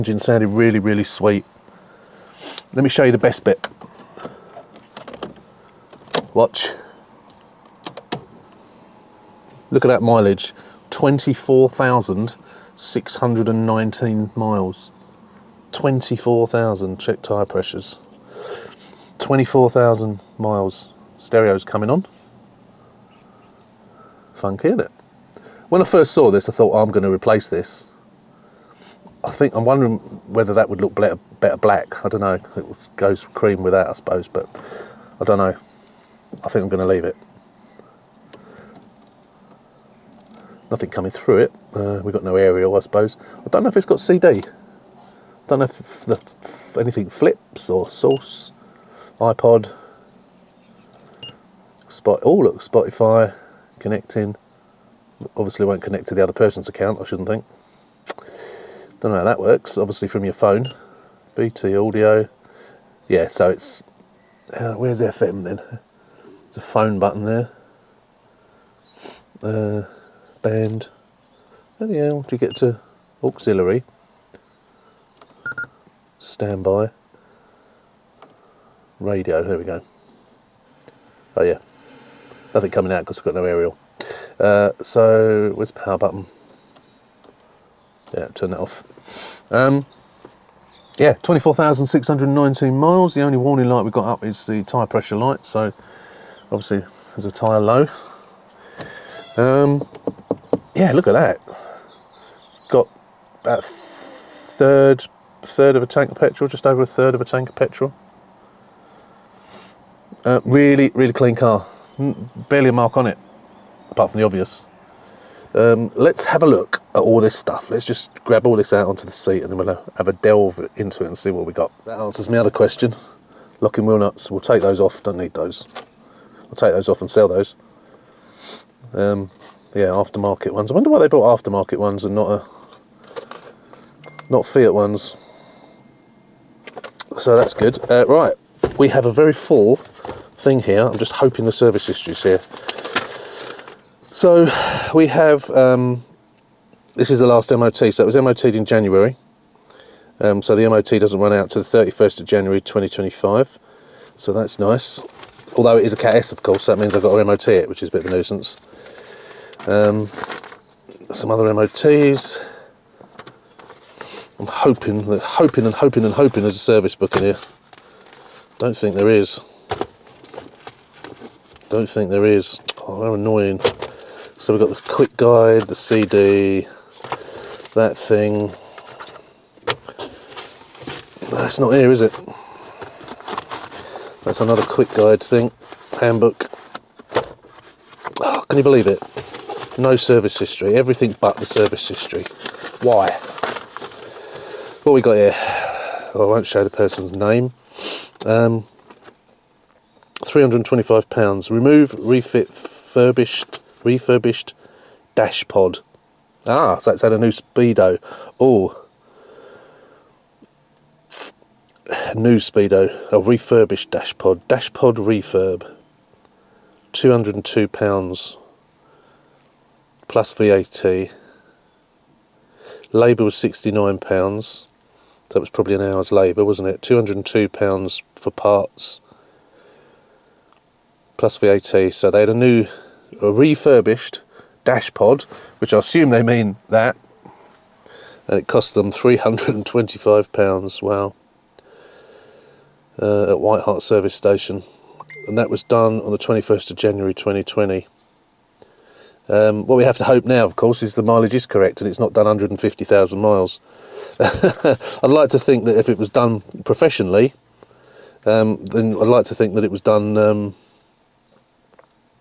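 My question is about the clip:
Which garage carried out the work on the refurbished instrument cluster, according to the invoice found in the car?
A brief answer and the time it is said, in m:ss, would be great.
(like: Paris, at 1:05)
White Hart Service Station, at 4:03.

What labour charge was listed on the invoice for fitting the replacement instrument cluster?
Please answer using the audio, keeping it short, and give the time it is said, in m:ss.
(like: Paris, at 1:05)
£69, at 3:43.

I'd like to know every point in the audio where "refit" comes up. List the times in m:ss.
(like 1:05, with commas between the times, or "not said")
3:21.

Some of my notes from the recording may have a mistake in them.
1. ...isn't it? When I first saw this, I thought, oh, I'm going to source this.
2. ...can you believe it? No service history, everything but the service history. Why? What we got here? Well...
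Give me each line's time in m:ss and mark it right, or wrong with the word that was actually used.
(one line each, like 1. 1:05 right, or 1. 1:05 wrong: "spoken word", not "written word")
1. 0:24 wrong: "replace", not "source"
2. 3:08 right.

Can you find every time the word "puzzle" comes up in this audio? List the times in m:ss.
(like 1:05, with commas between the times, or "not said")
not said.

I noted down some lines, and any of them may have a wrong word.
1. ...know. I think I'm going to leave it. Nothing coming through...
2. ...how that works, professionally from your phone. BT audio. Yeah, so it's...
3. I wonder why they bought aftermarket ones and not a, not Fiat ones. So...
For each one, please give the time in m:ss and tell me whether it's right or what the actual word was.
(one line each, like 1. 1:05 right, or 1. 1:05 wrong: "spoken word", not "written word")
1. 0:35 right
2. 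0:59 wrong: "obviously", not "professionally"
3. 2:10 right.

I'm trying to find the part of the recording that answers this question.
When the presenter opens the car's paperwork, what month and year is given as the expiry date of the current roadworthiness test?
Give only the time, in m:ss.
2:31.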